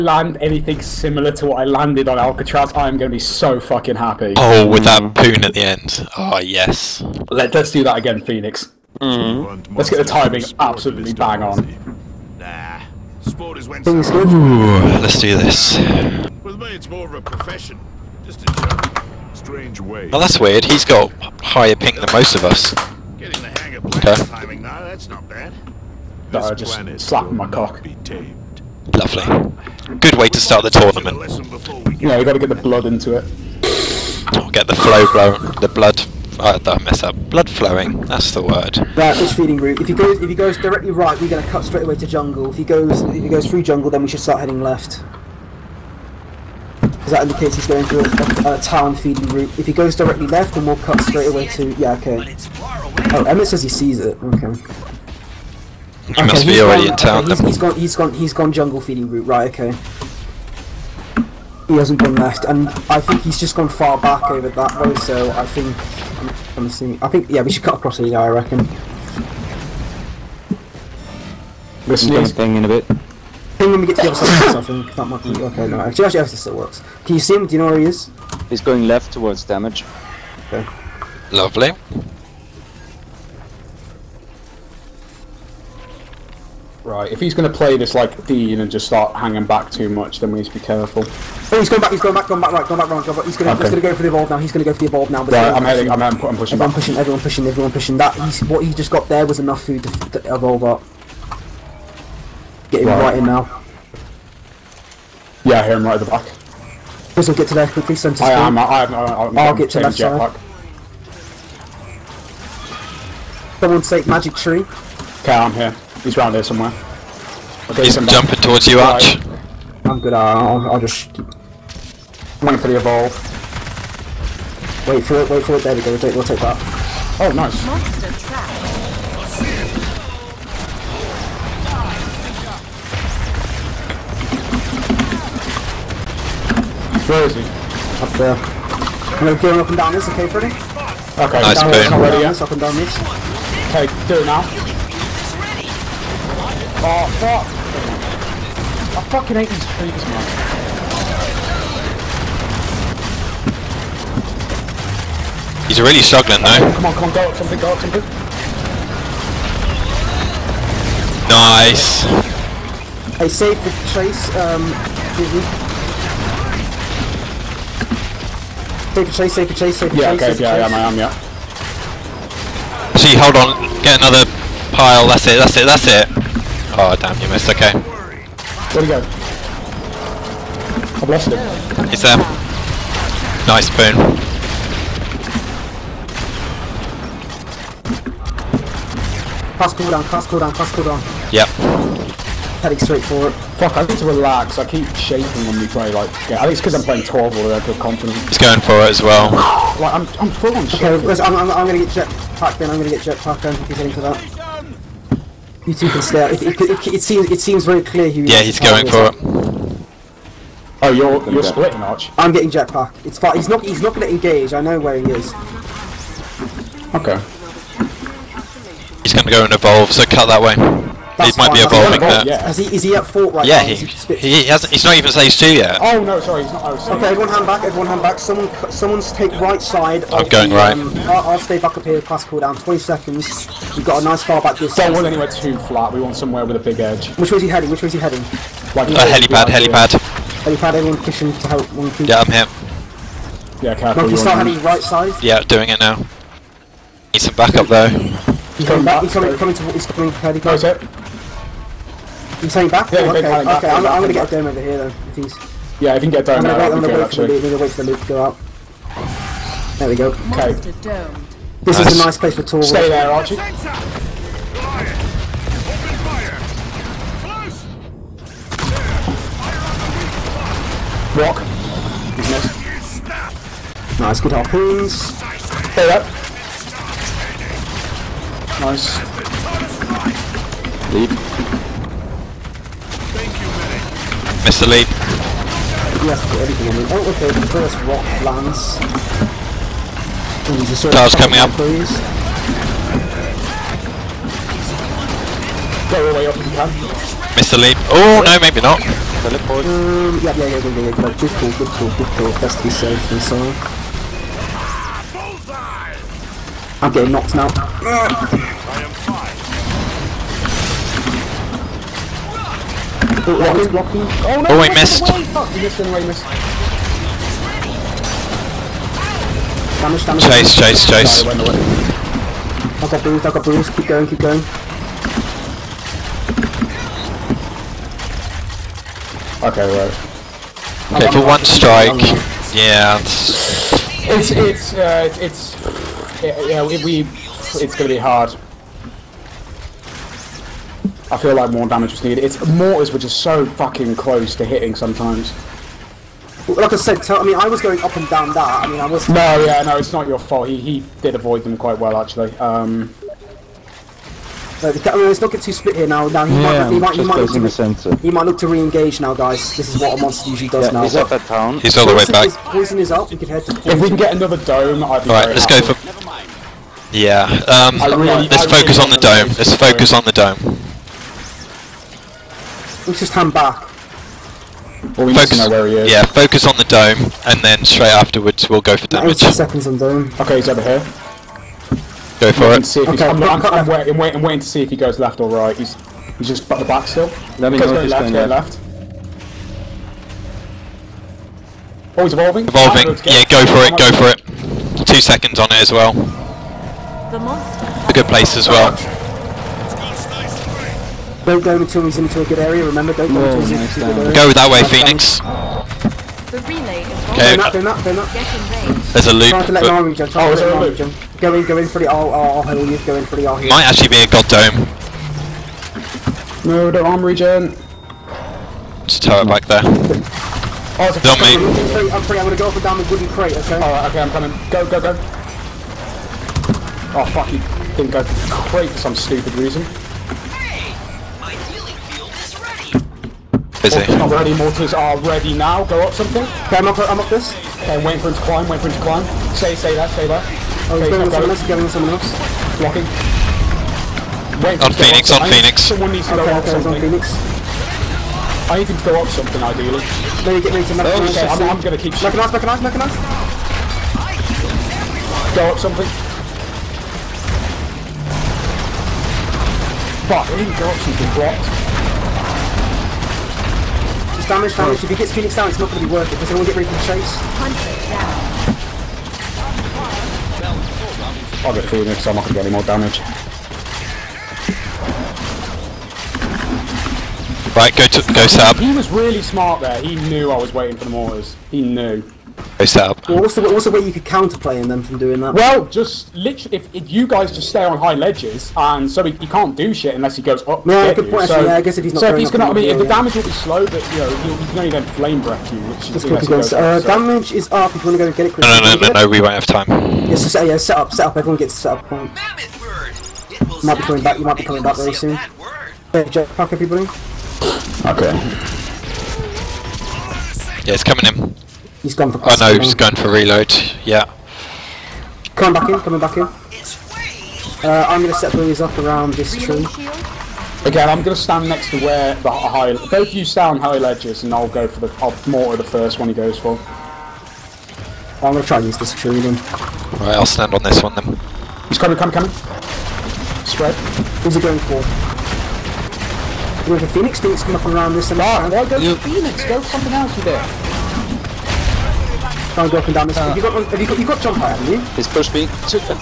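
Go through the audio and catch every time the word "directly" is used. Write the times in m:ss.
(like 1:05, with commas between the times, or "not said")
0:40, 0:49.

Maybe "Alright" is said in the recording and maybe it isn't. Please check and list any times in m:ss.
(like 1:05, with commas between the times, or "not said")
7:03, 8:50.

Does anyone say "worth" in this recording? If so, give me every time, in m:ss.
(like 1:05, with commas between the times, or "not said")
7:45.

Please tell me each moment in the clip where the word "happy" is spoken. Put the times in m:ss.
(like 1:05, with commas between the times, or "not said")
0:03, 6:05.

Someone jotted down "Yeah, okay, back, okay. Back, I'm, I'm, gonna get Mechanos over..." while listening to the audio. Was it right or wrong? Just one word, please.
wrong.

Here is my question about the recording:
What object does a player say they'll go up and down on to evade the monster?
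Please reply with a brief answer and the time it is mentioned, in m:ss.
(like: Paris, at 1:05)
Wooden crate, at 7:02.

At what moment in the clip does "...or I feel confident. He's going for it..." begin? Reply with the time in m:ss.
3:17.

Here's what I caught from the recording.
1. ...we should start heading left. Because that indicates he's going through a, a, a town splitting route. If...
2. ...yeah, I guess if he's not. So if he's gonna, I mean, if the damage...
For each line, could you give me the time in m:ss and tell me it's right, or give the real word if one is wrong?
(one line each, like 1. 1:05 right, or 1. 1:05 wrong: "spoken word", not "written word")
1. 0:44 wrong: "feeding", not "splitting"
2. 8:11 right.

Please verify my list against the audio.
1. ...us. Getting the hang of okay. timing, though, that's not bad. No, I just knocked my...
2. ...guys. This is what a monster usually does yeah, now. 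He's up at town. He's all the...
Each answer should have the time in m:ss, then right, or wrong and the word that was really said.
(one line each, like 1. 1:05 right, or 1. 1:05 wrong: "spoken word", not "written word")
1. 0:22 wrong: "slapped", not "knocked"
2. 5:59 right.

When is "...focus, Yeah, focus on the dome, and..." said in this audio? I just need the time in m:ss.
6:15.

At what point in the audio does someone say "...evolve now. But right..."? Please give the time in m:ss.
1:34.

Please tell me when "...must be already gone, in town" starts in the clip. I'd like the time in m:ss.
0:56.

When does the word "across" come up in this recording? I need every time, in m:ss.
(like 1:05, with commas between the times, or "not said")
1:07.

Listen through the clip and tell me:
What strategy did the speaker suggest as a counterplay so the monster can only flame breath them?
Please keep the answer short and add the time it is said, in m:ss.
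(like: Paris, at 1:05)
Stay on high ledges, at 8:07.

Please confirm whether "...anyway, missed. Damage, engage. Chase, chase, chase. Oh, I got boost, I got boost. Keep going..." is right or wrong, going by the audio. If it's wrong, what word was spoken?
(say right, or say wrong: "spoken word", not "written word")
wrong: "damage", not "engage".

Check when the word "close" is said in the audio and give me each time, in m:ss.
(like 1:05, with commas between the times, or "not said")
4:10, 5:43.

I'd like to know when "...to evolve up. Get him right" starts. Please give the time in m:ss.
1:40.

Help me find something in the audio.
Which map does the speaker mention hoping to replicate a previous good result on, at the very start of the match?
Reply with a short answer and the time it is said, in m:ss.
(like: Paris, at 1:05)
Alcatraz, at 0:02.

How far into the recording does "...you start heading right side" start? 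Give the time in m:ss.
4:04.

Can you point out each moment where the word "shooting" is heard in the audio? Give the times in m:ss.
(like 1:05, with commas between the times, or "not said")
7:31.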